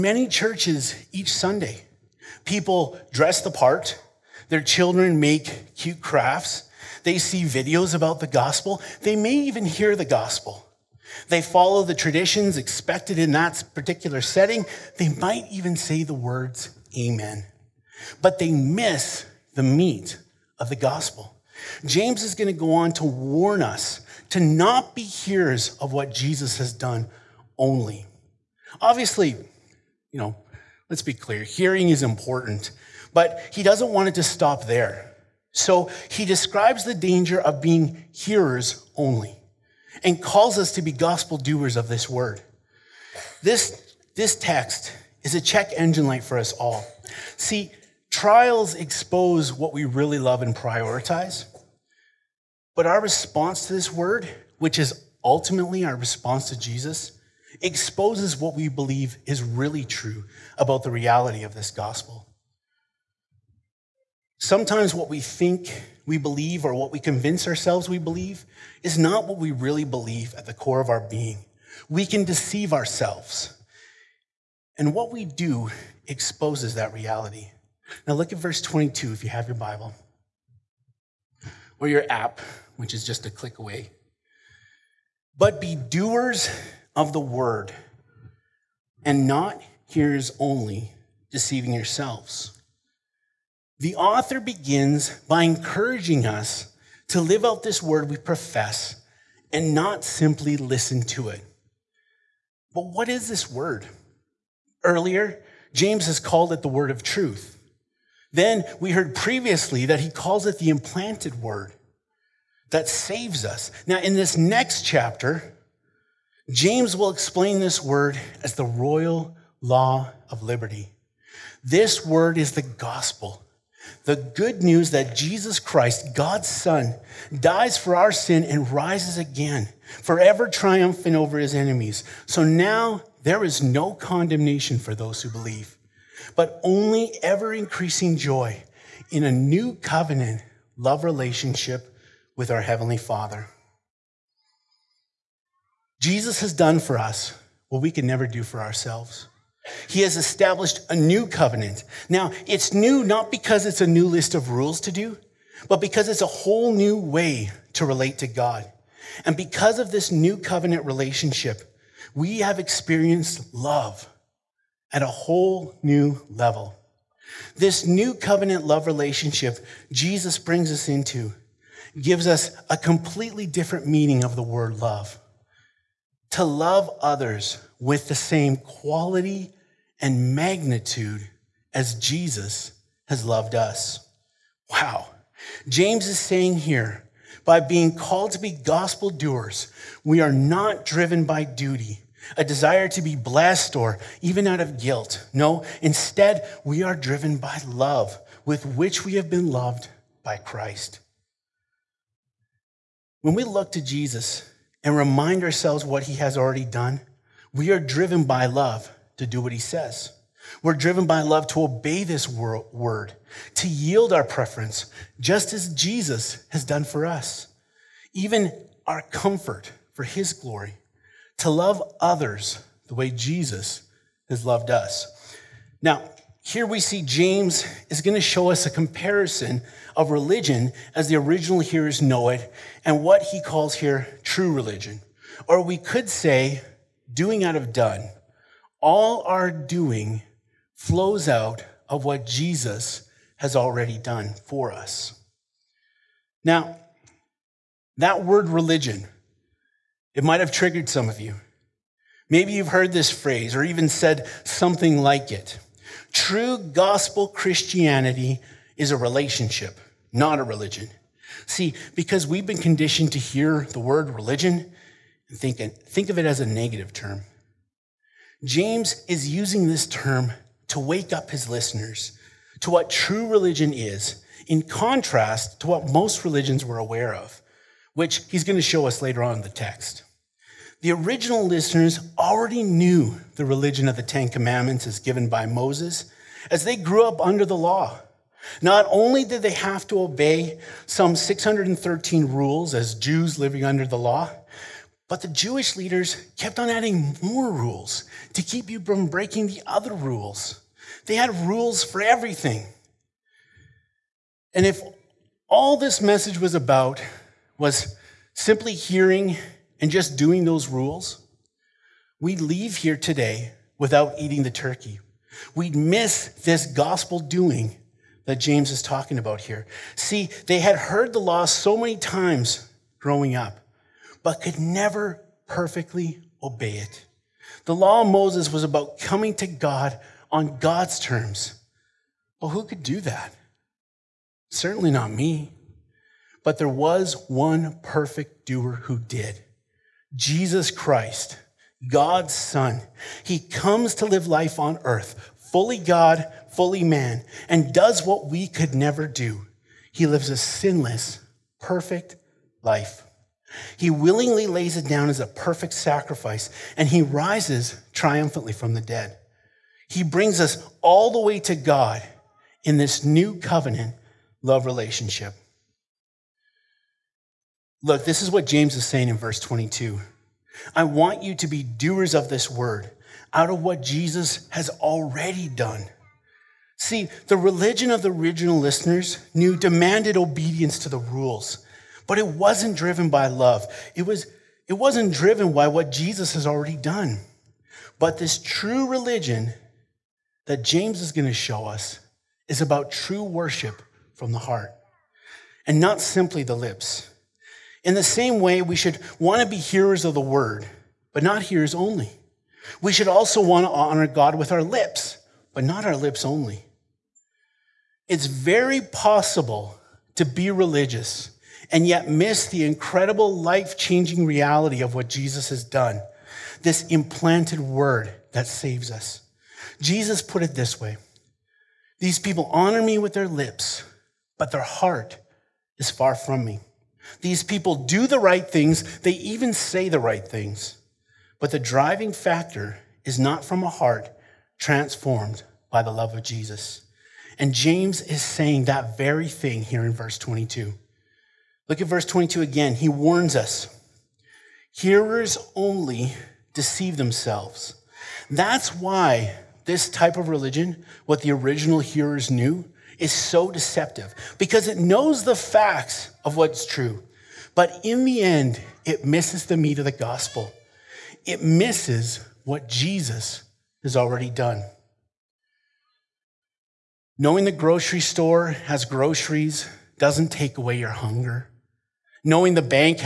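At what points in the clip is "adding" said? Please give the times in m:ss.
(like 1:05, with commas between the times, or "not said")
4:56.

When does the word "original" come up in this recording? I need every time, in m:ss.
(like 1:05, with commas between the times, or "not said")
3:51, 4:40, 6:18, 7:31.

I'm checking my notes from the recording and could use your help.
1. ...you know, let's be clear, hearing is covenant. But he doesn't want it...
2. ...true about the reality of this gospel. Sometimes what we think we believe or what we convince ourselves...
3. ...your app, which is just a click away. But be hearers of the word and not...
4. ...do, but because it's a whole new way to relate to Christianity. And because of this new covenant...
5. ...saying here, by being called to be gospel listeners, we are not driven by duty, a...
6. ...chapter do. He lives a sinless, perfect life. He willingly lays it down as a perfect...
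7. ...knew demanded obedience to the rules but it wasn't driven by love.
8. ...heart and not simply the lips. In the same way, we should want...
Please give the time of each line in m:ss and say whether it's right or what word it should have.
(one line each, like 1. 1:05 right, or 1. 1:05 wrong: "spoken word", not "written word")
1. 0:30 wrong: "important", not "covenant"
2. 0:59 right
3. 1:21 wrong: "doers", not "hearers"
4. 2:34 wrong: "God", not "Christianity"
5. 3:06 wrong: "doers", not "listeners"
6. 5:48 wrong: "never", not "chapter"
7. 6:19 right
8. 6:34 right.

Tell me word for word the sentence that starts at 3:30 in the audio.
We're driven by love to obey this word, to yield our preference, just as Jesus has done for us.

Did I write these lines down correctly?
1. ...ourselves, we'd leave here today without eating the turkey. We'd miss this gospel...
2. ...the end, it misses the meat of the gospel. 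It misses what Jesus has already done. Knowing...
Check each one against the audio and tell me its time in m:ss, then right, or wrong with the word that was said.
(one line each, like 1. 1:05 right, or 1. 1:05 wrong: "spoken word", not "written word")
1. 5:10 wrong: "rules", not "ourselves"
2. 7:38 right.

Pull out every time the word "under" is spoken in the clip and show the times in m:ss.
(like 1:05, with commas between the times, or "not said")
4:47, 4:53.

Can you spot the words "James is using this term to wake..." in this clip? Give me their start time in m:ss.
4:28.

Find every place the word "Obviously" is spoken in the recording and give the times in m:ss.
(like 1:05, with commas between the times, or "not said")
0:28.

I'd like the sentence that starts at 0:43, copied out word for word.
This, this text is a check engine light for us all.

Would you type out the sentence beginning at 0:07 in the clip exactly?
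They see videos about the gospel.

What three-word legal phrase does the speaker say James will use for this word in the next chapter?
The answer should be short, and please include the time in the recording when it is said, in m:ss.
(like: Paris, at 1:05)
Royal law of liberty, at 1:58.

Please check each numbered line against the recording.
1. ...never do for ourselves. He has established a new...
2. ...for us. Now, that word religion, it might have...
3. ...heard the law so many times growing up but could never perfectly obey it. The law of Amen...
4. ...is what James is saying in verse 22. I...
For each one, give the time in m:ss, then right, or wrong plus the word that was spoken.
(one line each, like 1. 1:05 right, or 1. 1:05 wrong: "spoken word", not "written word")
1. 2:28 right
2. 4:04 right
3. 5:20 wrong: "Moses", not "Amen"
4. 6:08 right.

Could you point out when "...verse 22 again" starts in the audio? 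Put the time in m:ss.
7:21.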